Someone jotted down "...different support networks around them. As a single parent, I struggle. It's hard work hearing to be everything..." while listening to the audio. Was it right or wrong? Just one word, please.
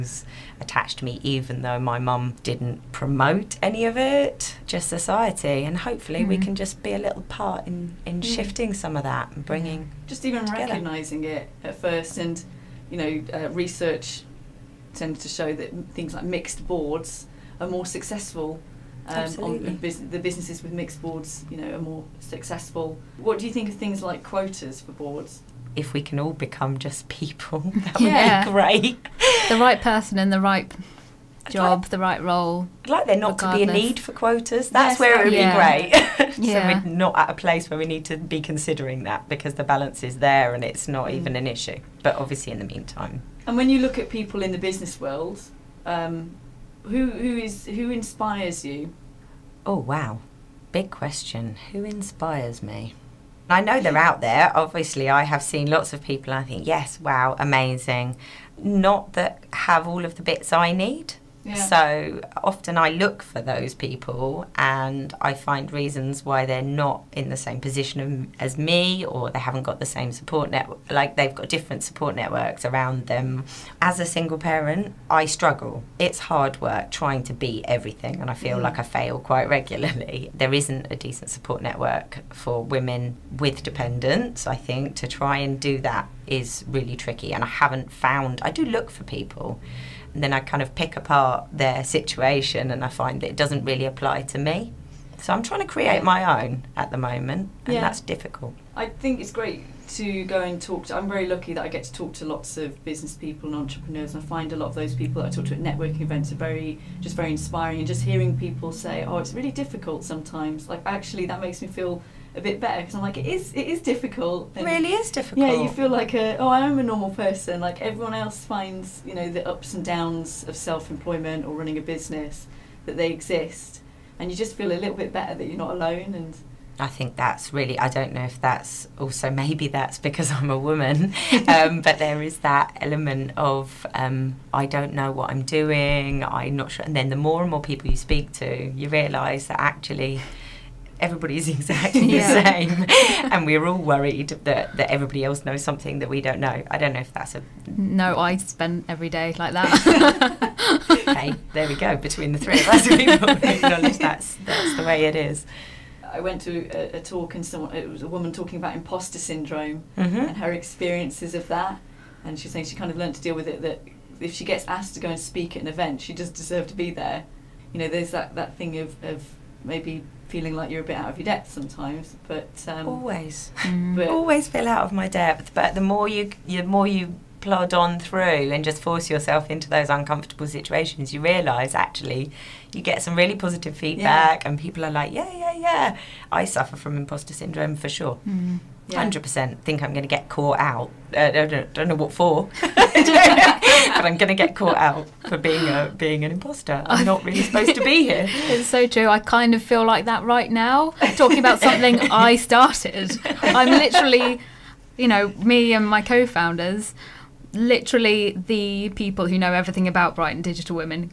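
wrong.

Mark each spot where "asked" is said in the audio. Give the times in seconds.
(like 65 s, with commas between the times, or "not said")
164 s.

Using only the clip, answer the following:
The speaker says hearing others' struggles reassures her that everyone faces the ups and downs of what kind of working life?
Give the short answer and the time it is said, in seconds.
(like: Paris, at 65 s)
self employment, at 120 s.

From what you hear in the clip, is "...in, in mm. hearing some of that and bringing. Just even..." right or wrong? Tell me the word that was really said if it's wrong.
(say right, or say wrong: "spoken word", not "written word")
wrong: "shifting", not "hearing".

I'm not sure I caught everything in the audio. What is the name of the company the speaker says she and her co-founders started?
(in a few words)
Brighton Digital.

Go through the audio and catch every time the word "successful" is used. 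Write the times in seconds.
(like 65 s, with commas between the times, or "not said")
17 s, 22 s.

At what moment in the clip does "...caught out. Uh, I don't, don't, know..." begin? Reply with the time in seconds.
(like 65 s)
190 s.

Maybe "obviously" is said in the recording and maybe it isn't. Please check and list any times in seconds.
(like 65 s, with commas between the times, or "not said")
42 s, 54 s.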